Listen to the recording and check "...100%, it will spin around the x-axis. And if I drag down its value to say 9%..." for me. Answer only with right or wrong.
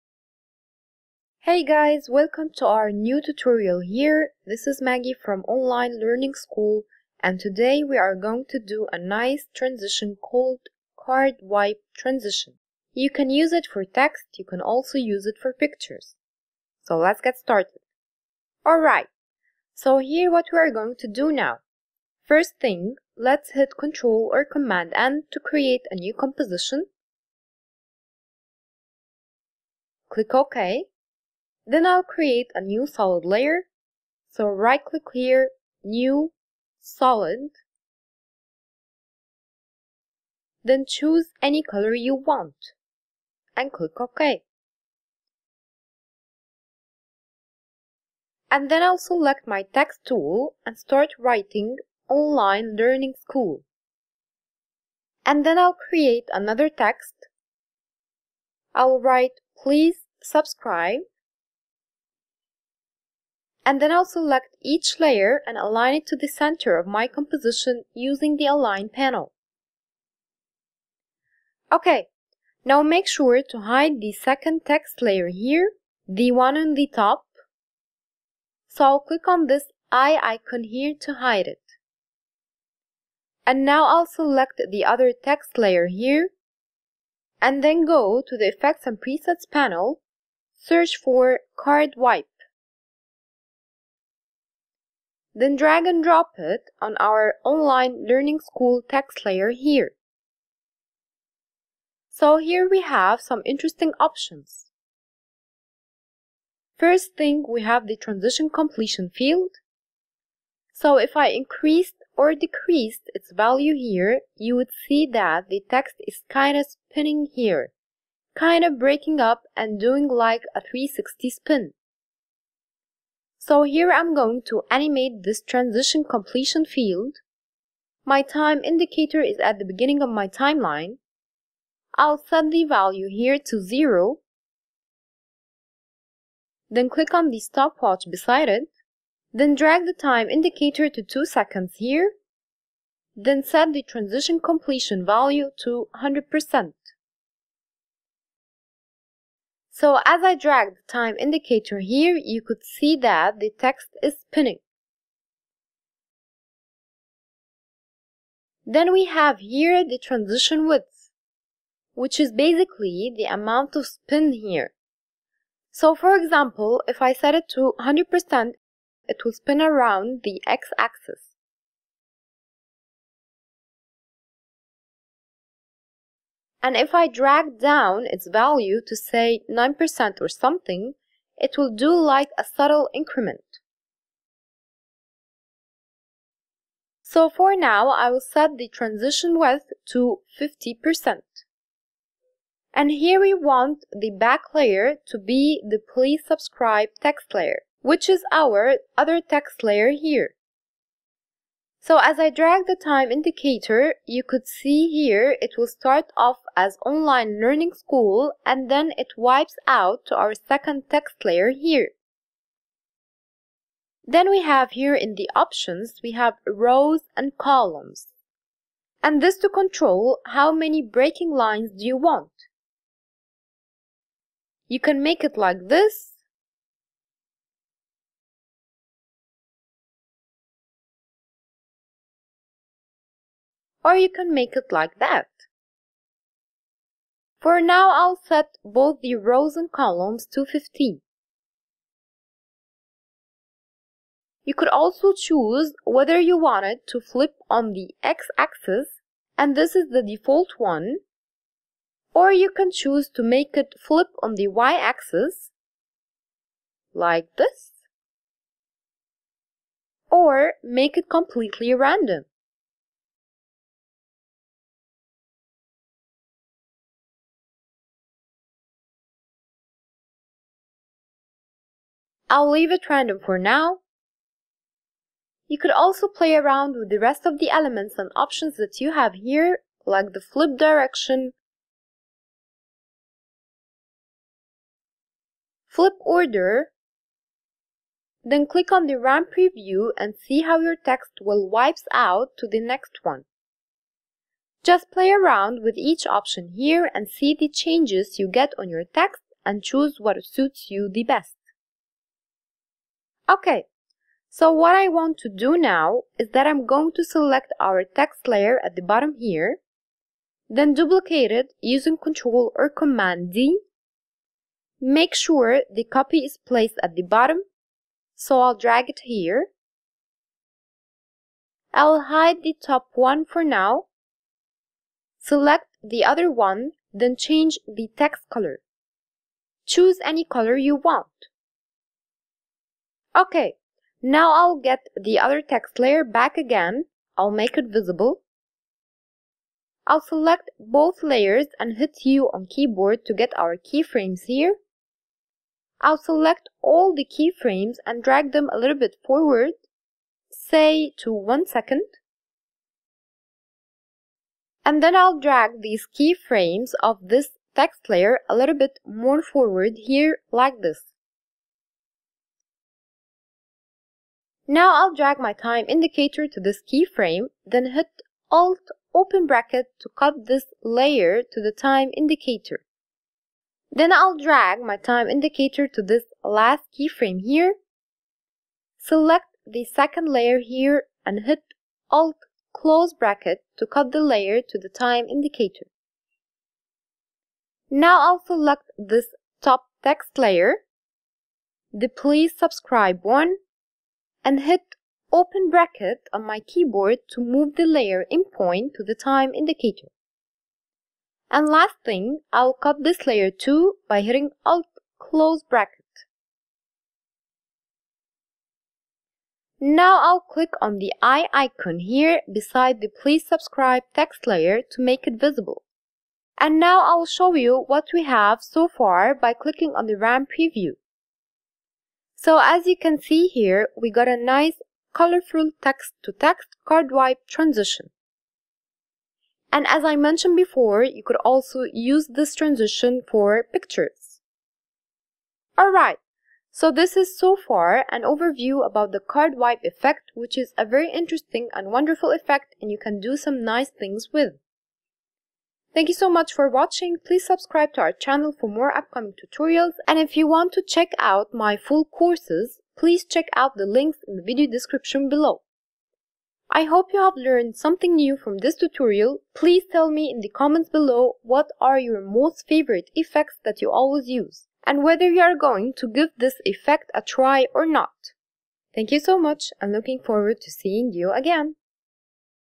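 right.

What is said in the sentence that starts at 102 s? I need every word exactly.
So here we have some interesting options.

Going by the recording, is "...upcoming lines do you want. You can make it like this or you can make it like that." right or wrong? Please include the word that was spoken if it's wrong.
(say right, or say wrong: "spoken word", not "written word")
wrong: "breaking", not "upcoming".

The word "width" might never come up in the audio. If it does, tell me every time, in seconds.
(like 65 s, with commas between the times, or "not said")
160 s, 189 s.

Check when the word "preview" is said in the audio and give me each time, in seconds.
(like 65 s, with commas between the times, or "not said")
289 s, 420 s.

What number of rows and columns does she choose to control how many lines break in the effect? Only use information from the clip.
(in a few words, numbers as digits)
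15.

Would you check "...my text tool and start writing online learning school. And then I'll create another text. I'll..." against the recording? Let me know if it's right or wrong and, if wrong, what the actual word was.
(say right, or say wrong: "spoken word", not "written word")
right.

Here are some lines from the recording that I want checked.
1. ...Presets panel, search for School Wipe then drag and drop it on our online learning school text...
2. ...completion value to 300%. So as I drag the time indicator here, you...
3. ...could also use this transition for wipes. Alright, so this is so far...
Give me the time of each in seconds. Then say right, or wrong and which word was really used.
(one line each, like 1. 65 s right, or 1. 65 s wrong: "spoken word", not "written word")
1. 88 s wrong: "Card", not "School"
2. 144 s wrong: "100", not "300"
3. 431 s wrong: "pictures", not "wipes".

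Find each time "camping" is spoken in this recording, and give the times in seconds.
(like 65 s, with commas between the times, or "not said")
not said.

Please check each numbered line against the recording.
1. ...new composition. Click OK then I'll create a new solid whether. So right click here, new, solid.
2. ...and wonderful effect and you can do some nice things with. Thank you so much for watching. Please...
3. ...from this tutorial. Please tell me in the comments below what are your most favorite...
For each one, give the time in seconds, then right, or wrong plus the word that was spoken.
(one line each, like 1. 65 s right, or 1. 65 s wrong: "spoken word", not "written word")
1. 25 s wrong: "layer", not "whether"
2. 441 s right
3. 458 s right.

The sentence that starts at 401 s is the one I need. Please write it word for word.
And last thing, I'll cut this layer too by hitting Alt close bracket.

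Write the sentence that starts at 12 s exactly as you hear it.
You can use it for text, you can also use it for pictures.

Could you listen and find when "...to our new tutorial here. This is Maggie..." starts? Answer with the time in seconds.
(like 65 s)
2 s.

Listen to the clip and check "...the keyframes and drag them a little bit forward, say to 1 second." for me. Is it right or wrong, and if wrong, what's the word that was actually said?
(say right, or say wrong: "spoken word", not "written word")
right.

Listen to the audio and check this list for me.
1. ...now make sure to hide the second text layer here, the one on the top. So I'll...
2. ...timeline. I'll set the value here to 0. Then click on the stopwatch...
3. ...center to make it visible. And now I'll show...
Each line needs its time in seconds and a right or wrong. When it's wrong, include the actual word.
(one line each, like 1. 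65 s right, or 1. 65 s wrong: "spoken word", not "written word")
1. 72 s right
2. 130 s right
3. 414 s wrong: "layer", not "center".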